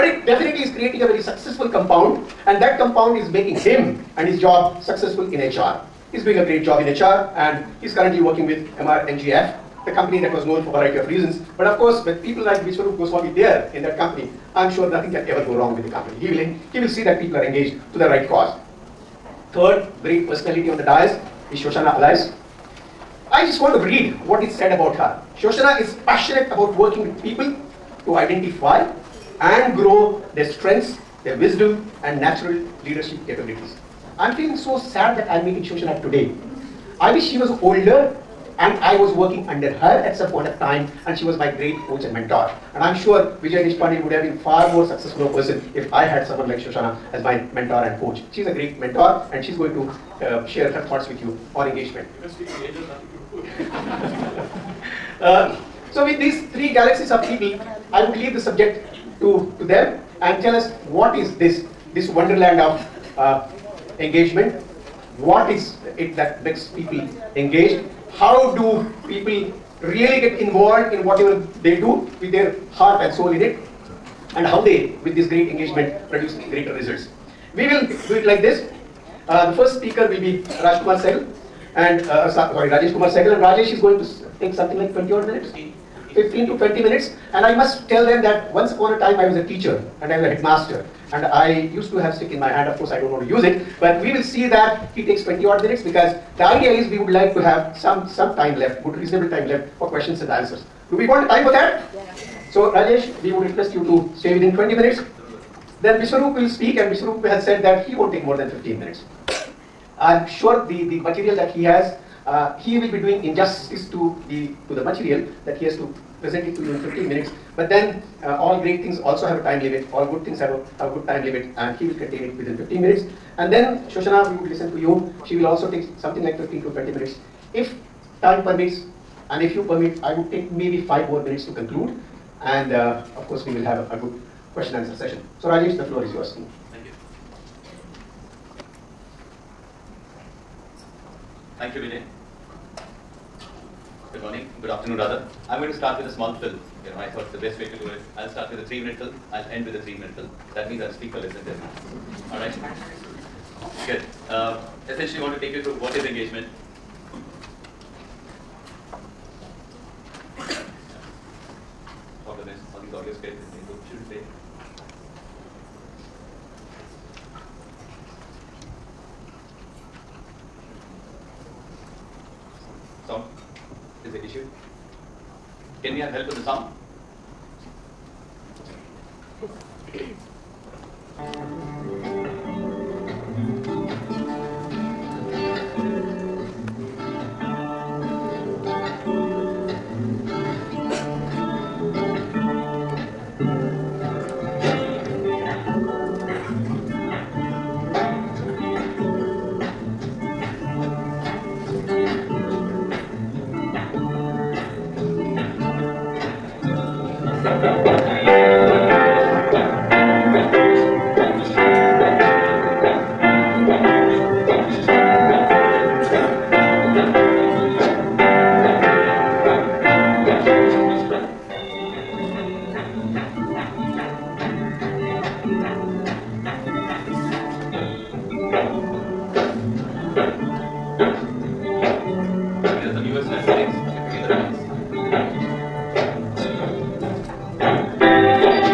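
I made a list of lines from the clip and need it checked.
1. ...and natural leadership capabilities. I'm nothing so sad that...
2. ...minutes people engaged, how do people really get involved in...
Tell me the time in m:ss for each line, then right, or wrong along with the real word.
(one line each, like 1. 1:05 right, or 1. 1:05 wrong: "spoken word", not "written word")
1. 0:32 wrong: "feeling", not "nothing"
2. 1:06 wrong: "makes", not "minutes".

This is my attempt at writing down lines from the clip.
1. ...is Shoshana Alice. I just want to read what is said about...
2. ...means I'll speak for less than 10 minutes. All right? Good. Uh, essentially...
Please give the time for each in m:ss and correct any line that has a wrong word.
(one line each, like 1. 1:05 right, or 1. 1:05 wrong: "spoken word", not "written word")
1. 0:21 right
2. 2:30 right.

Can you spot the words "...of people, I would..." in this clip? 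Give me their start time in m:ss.
0:57.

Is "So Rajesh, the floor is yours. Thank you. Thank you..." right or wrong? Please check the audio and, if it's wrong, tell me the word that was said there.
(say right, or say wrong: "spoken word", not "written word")
right.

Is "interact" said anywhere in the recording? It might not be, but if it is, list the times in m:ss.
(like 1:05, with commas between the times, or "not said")
not said.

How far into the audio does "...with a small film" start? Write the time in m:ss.
2:25.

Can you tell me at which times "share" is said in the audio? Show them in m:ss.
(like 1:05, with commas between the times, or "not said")
0:50.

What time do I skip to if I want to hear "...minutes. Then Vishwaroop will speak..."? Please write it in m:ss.
1:44.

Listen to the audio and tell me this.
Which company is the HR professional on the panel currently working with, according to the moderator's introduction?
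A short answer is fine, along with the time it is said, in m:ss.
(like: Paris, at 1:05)
MRNGF, at 0:08.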